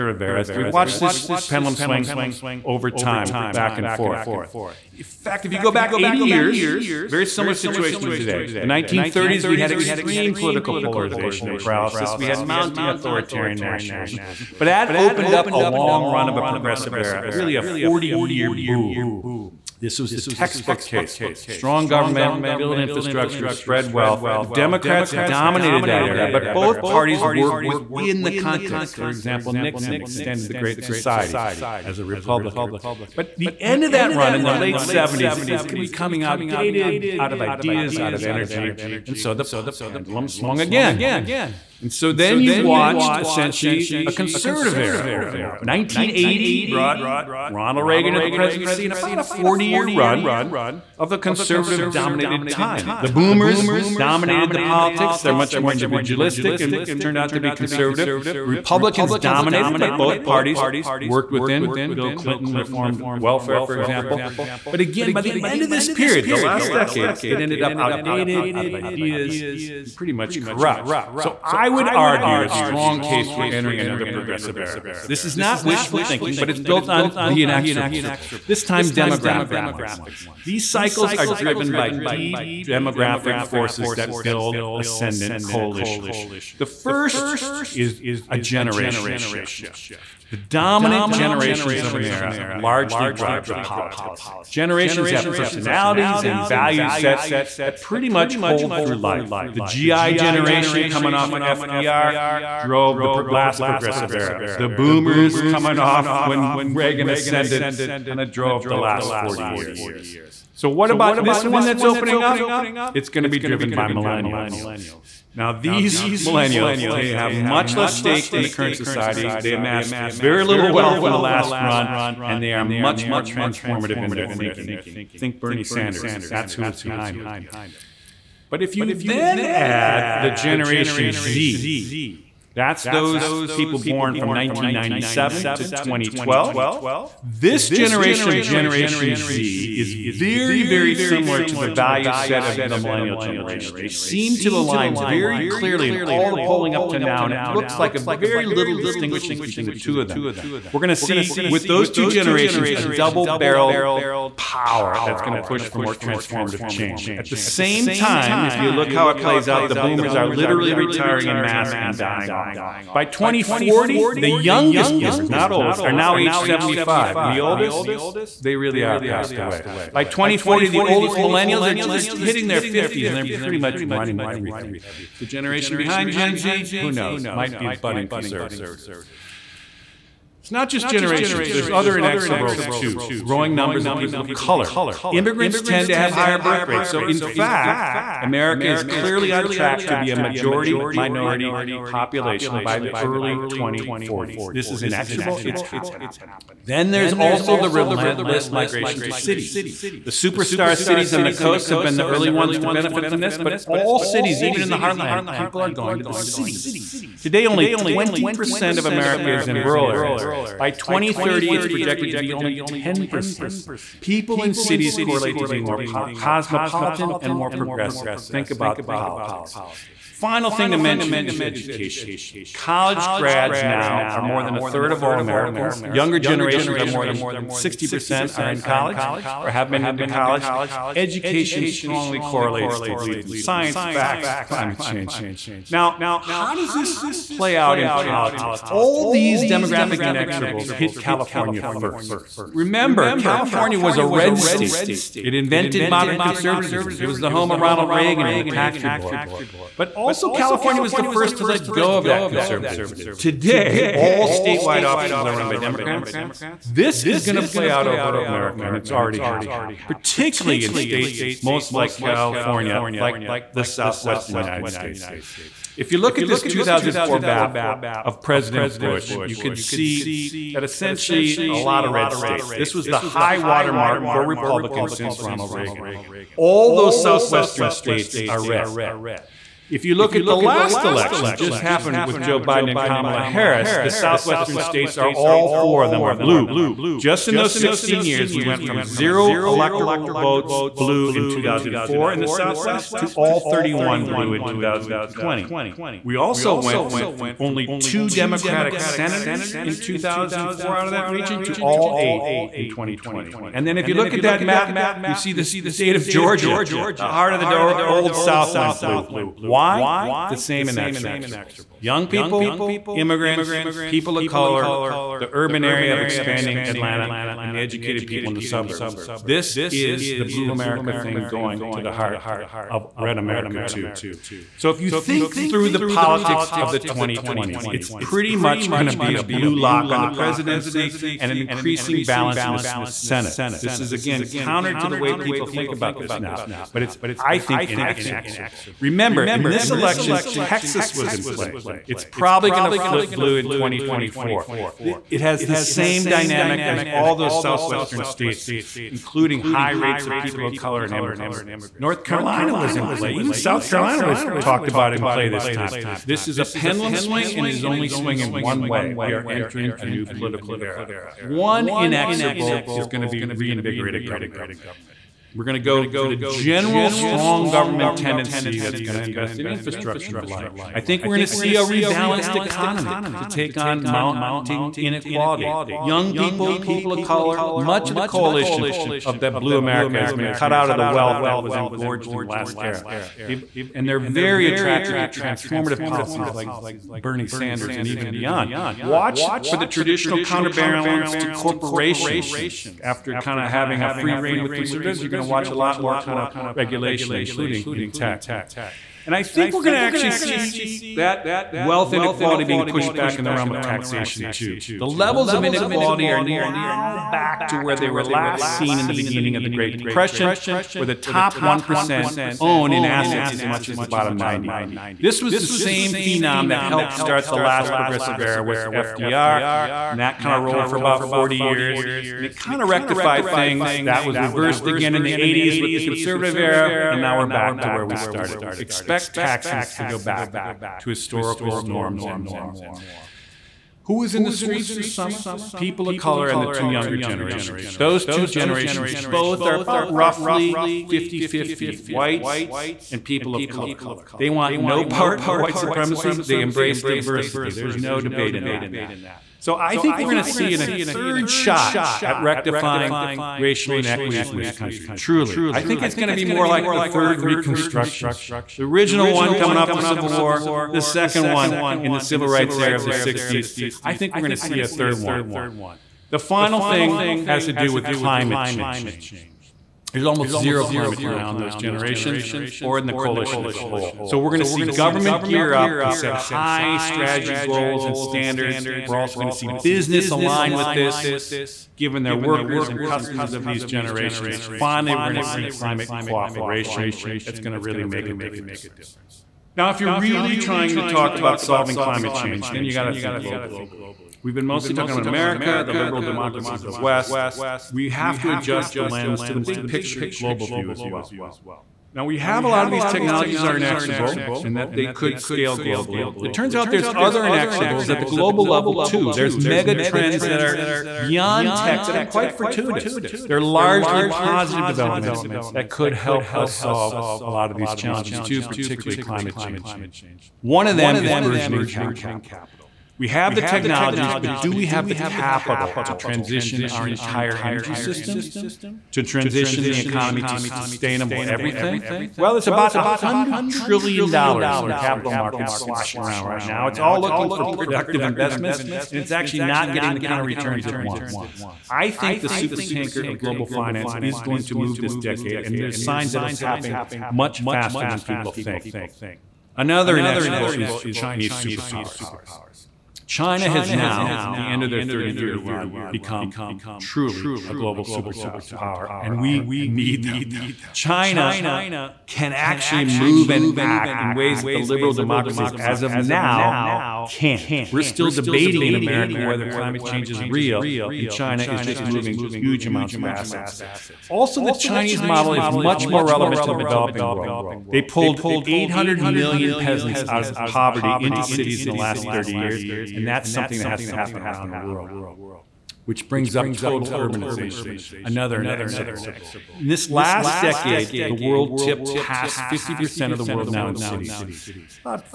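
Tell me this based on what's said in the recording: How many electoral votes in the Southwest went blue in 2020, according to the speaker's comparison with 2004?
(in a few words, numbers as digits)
31.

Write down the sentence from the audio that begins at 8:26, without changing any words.
It turns out there's other inexorables at the global level too.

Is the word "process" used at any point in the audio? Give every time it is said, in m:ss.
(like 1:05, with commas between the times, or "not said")
not said.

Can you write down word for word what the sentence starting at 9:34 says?
Also, the Chinese model is much more relevant to the developing world.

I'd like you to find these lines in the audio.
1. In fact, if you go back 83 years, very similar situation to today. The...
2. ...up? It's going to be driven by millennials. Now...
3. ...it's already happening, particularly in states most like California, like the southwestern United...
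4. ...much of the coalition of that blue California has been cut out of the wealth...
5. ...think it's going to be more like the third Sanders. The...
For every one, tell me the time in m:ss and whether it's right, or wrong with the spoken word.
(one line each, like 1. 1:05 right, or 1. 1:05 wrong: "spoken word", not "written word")
1. 0:04 wrong: "80", not "83"
2. 1:52 right
3. 4:18 right
4. 6:17 wrong: "America", not "California"
5. 7:35 wrong: "Reconstruction", not "Sanders".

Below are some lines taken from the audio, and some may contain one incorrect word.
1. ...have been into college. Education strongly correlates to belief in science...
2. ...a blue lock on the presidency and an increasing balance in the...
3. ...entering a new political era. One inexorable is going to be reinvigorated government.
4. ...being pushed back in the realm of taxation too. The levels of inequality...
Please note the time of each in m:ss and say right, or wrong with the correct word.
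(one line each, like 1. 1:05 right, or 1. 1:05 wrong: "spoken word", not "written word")
1. 3:49 right
2. 5:29 right
3. 5:59 right
4. 6:42 right.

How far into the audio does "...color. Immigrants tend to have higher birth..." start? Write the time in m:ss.
3:04.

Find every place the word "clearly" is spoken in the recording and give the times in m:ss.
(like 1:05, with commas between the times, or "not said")
2:25, 3:08.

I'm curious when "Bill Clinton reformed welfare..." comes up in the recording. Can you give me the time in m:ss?
1:01.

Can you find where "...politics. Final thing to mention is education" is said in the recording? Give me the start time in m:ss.
3:38.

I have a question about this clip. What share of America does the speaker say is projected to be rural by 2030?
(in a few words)
10%.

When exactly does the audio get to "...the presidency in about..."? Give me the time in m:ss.
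0:48.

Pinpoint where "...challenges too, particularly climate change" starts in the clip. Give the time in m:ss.
8:37.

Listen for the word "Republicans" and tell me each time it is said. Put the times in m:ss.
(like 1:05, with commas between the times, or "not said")
0:32, 0:58, 4:34.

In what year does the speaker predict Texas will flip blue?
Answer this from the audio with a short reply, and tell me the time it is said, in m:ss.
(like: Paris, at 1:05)
2024, at 5:43.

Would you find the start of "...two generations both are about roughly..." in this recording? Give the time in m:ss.
7:18.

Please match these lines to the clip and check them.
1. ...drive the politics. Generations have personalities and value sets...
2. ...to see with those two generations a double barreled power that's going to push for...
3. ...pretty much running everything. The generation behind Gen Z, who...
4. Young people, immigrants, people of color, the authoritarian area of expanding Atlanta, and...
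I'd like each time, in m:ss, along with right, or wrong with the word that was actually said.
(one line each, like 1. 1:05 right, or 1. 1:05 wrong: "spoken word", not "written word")
1. 1:33 right
2. 2:30 right
3. 2:53 right
4. 5:11 wrong: "urban", not "authoritarian".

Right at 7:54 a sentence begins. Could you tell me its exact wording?
So we're going to see government gear up and set high strategy goals and standards.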